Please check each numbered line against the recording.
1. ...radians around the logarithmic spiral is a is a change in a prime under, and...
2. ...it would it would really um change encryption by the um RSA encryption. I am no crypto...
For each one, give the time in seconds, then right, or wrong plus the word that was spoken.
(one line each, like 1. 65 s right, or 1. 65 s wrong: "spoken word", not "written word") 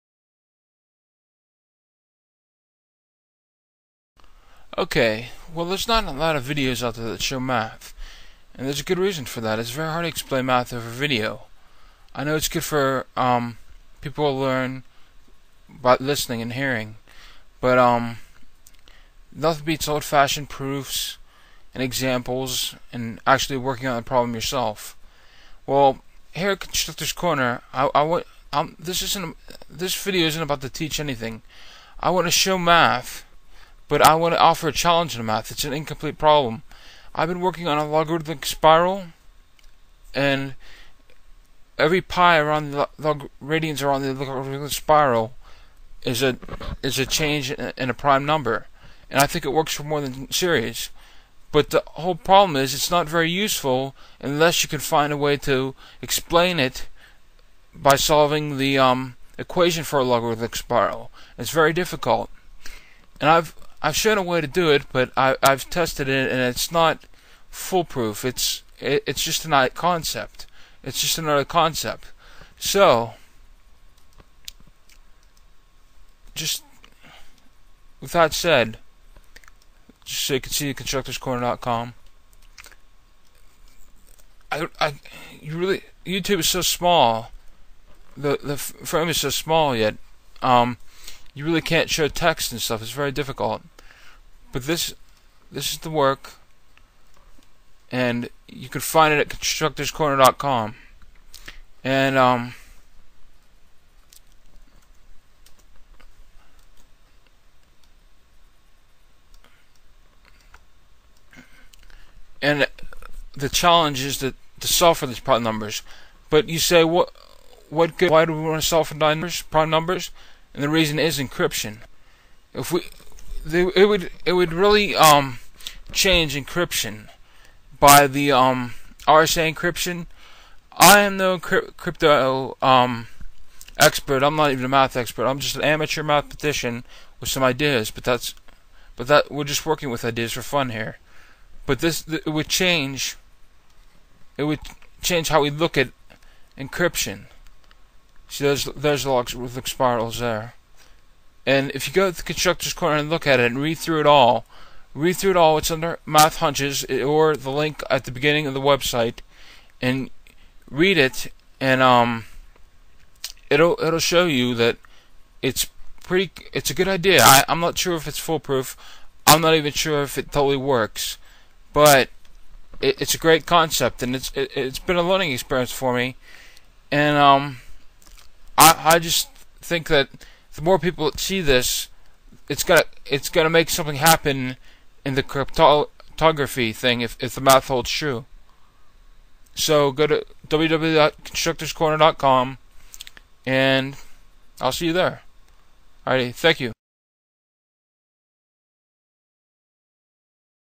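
1. 43 s wrong: "number", not "under"
2. 123 s right.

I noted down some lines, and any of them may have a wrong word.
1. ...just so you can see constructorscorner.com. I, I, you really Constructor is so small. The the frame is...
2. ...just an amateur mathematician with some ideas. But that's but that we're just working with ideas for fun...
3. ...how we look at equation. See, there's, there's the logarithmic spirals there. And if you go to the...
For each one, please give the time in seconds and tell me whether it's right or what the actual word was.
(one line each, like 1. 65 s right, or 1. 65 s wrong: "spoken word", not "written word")
1. 80 s wrong: "YouTube", not "Constructor"
2. 135 s right
3. 145 s wrong: "encryption", not "equation".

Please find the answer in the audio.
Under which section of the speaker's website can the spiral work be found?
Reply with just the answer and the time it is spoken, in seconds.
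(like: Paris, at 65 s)
Math hunches, at 156 s.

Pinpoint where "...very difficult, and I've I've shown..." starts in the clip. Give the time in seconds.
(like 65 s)
61 s.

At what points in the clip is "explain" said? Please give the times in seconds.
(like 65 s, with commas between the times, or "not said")
10 s, 56 s.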